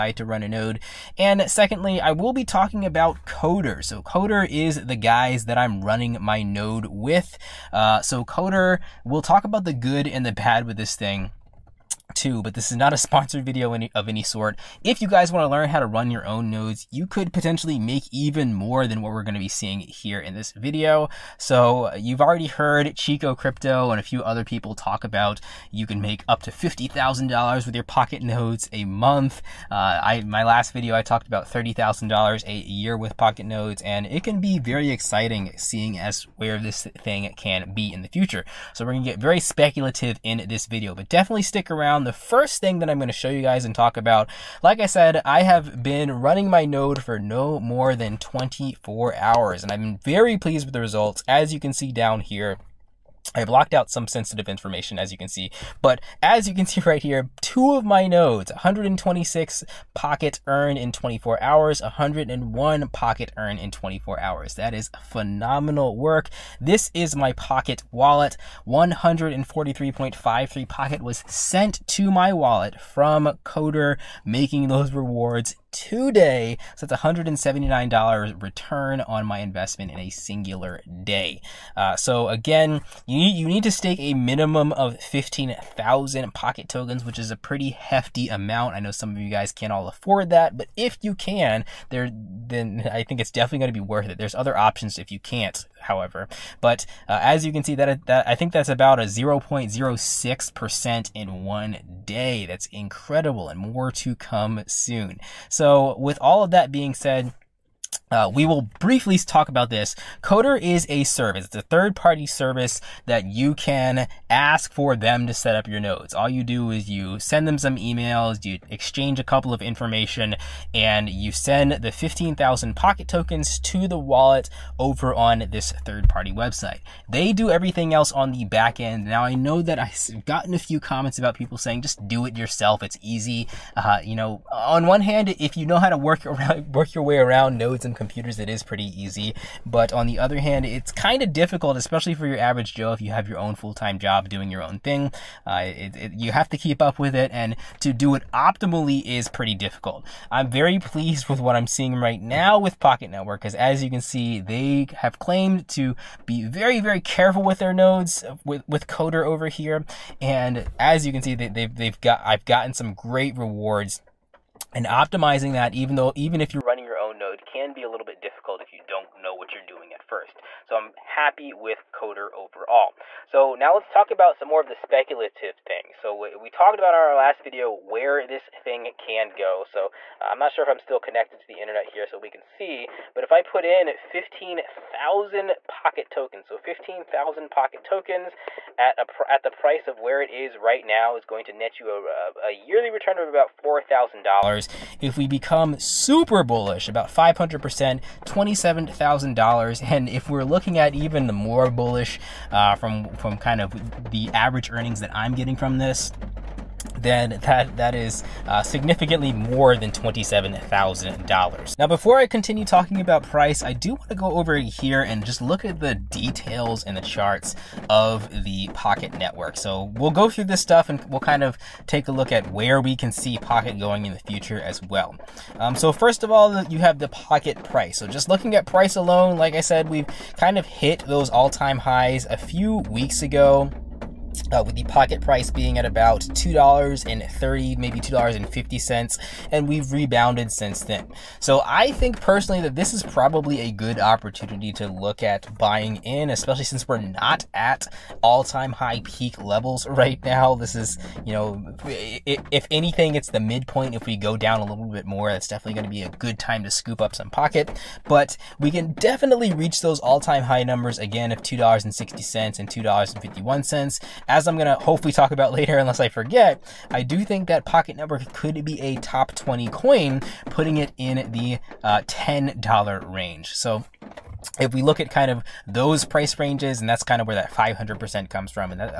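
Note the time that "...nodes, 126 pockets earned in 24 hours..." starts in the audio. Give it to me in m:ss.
0:58.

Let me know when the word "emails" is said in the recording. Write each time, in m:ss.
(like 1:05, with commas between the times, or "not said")
1:57.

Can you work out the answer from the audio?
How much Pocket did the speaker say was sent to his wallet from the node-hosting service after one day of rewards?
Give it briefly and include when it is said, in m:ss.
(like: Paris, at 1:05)
143.53, at 1:08.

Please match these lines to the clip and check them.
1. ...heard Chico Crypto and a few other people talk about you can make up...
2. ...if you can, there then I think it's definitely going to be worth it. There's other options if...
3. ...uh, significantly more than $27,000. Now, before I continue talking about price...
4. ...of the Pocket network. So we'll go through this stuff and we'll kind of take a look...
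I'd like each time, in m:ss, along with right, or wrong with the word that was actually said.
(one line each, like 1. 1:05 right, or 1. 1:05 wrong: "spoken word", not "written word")
1. 0:22 right
2. 1:30 right
3. 3:28 right
4. 3:37 right.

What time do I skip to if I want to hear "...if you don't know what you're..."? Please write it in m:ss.
2:48.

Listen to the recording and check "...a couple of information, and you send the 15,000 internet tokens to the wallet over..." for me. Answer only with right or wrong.
wrong.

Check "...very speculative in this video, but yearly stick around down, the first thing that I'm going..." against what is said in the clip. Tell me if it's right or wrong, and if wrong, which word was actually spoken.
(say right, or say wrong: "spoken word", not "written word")
wrong: "definitely", not "yearly".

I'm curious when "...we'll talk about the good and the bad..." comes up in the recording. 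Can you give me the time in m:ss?
0:09.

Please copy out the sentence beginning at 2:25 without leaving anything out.
Uh, it, it, you have to keep up with it, and to do it optimally is pretty difficult.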